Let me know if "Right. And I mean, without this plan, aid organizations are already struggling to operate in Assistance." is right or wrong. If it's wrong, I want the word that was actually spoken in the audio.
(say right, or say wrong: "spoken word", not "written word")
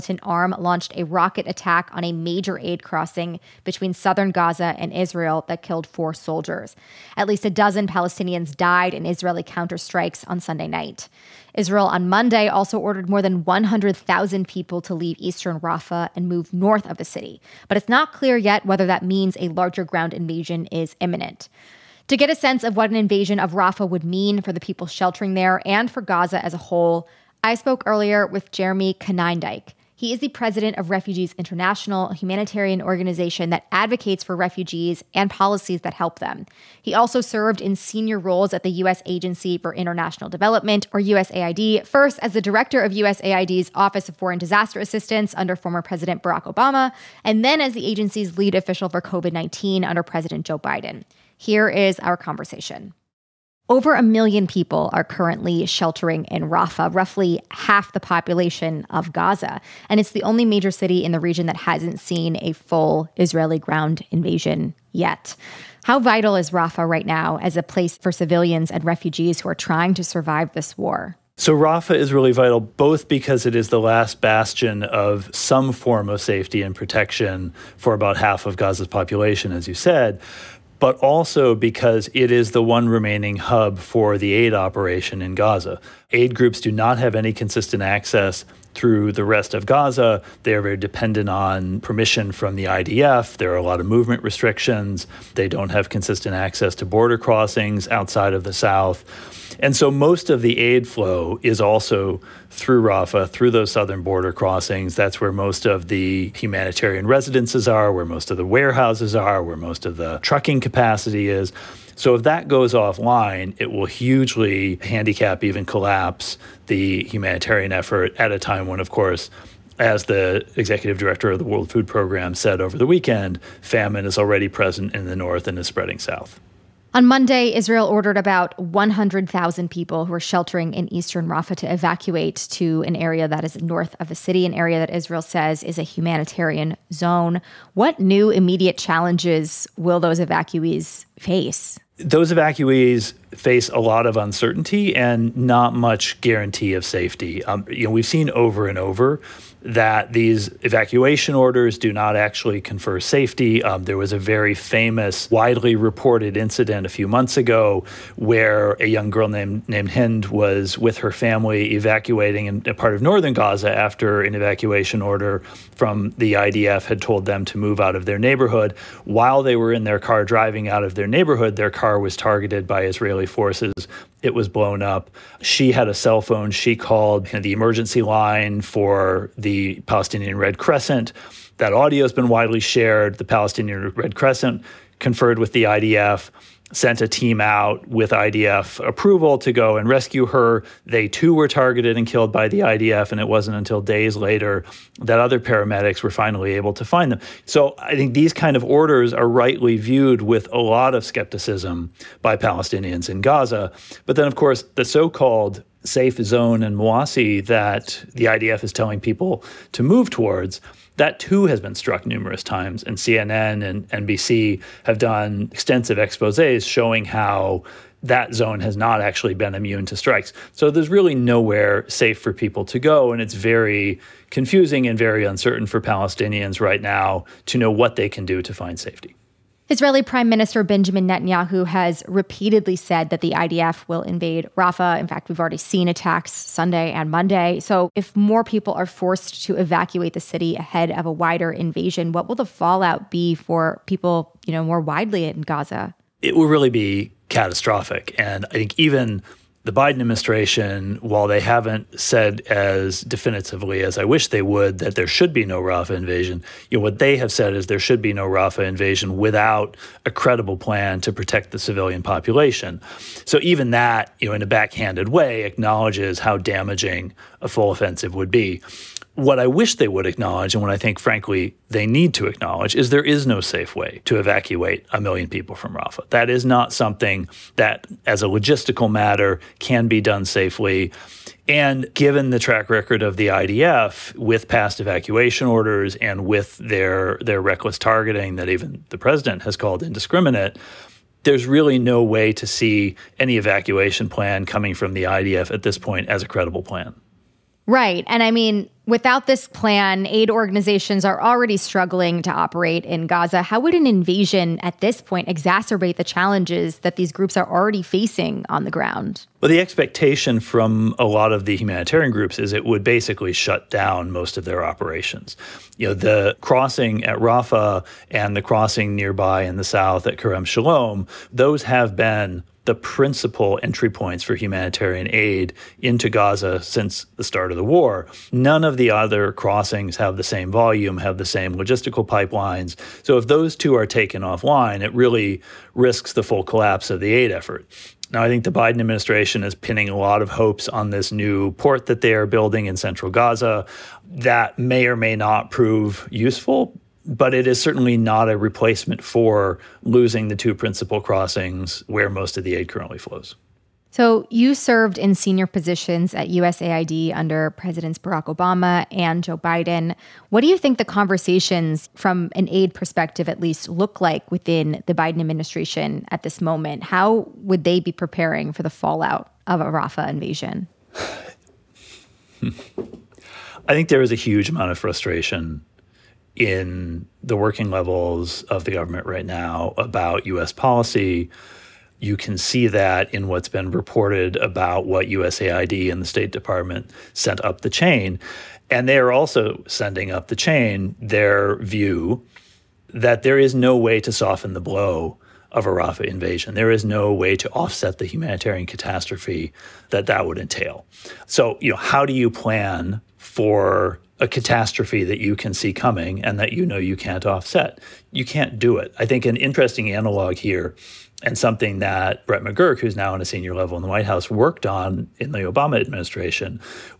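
wrong: "Gaza", not "Assistance".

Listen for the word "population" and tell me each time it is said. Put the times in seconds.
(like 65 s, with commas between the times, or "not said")
58 s, 78 s, 262 s.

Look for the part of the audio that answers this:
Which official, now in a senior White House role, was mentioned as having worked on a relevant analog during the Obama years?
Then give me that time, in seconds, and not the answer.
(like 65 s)
412 s.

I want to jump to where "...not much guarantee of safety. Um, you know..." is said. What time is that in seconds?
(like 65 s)
145 s.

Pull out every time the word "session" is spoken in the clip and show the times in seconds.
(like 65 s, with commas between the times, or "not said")
not said.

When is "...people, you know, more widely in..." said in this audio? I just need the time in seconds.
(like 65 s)
243 s.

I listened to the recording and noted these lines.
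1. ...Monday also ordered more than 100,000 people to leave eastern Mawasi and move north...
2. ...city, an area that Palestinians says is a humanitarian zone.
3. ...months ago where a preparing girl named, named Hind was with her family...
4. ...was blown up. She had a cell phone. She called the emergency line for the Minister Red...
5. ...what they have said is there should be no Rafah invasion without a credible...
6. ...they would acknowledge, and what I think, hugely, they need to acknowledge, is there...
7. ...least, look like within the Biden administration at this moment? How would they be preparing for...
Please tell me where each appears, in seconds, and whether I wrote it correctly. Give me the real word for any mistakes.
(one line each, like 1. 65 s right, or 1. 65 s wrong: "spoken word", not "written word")
1. 12 s wrong: "Rafah", not "Mawasi"
2. 134 s wrong: "Israel", not "Palestinians"
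3. 157 s wrong: "young", not "preparing"
4. 174 s wrong: "Palestinian", not "Minister"
5. 256 s right
6. 269 s wrong: "frankly", not "hugely"
7. 363 s right.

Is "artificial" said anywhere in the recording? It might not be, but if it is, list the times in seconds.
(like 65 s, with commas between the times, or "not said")
not said.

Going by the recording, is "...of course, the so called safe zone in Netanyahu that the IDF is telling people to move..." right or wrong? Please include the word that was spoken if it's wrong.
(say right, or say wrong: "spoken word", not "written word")
wrong: "Mawasi", not "Netanyahu".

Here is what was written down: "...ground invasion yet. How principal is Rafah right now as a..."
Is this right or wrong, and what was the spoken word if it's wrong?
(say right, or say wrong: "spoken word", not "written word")
wrong: "vital", not "principal".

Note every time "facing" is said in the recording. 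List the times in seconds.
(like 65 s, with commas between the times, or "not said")
307 s.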